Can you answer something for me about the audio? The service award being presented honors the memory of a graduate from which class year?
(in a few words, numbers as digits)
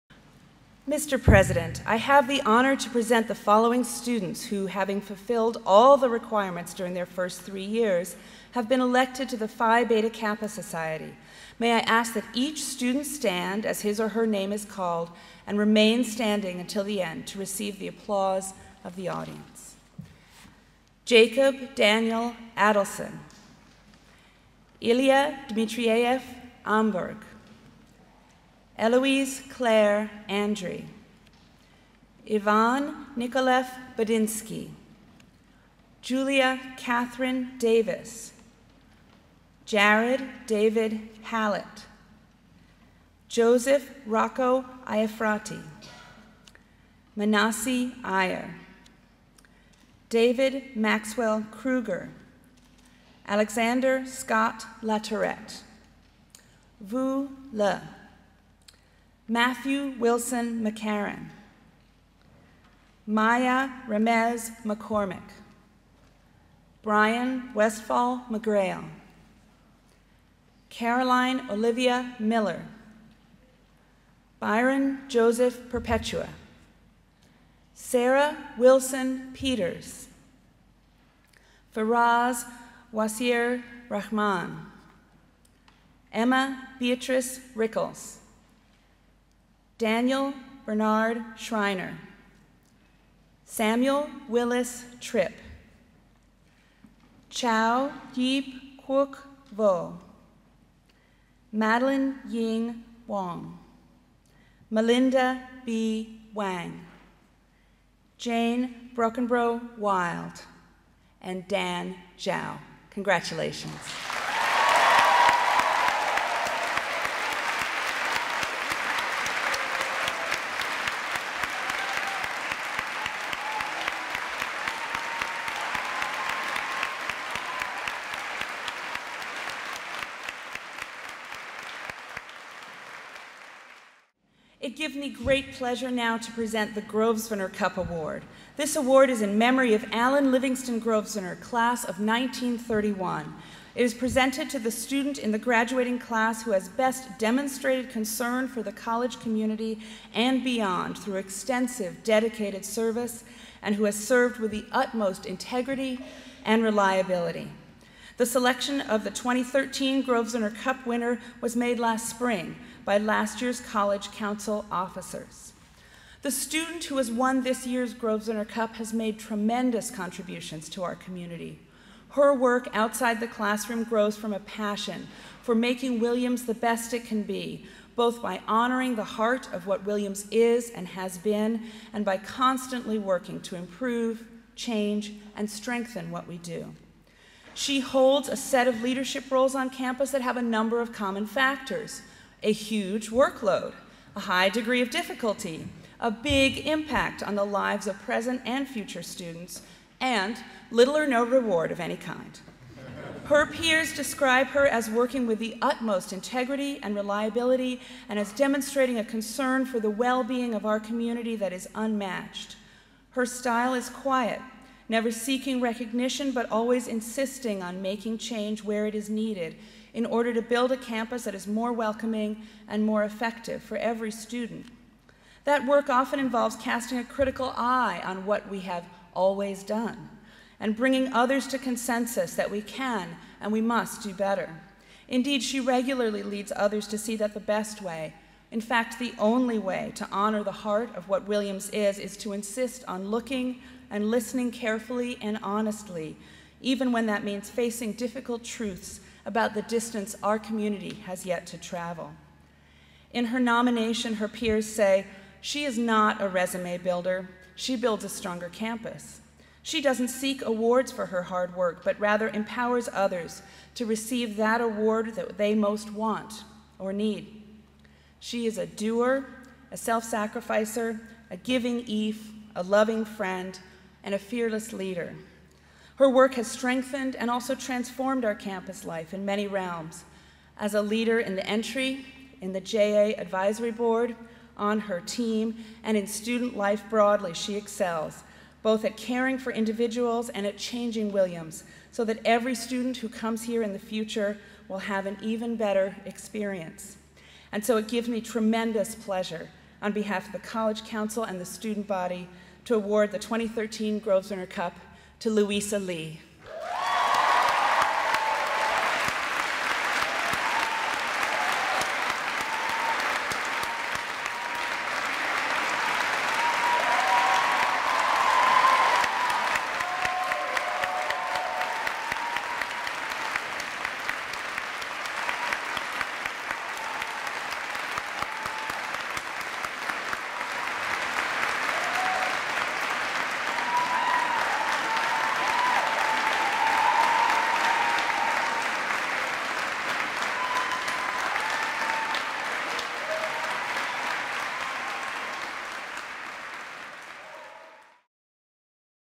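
1931.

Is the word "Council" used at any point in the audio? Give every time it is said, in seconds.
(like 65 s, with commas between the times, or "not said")
164 s, 300 s.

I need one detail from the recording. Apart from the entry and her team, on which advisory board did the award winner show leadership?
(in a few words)
JA advisory board.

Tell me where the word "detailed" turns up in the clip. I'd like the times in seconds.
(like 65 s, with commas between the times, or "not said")
not said.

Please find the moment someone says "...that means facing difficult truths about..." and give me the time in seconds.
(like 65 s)
247 s.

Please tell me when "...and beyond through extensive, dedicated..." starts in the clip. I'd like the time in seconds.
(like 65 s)
150 s.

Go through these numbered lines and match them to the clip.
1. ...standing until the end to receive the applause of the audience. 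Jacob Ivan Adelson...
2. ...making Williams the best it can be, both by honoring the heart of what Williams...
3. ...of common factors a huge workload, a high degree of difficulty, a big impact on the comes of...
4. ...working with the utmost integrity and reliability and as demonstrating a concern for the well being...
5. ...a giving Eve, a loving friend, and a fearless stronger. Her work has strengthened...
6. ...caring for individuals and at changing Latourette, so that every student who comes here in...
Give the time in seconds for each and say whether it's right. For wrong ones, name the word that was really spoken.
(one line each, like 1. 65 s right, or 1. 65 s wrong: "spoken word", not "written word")
1. 16 s wrong: "Daniel", not "Ivan"
2. 175 s right
3. 190 s wrong: "lives", not "comes"
4. 204 s right
5. 271 s wrong: "leader", not "stronger"
6. 288 s wrong: "Williams", not "Latourette".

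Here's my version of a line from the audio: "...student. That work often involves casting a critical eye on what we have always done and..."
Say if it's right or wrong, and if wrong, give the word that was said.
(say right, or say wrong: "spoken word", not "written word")
right.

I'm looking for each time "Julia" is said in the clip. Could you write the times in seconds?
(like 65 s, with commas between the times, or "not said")
36 s.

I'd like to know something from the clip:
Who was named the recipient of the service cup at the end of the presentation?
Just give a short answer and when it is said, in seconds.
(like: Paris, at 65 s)
Louisa Lee, at 305 s.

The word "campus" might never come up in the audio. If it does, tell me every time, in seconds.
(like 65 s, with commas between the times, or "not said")
189 s, 220 s, 258 s, 278 s.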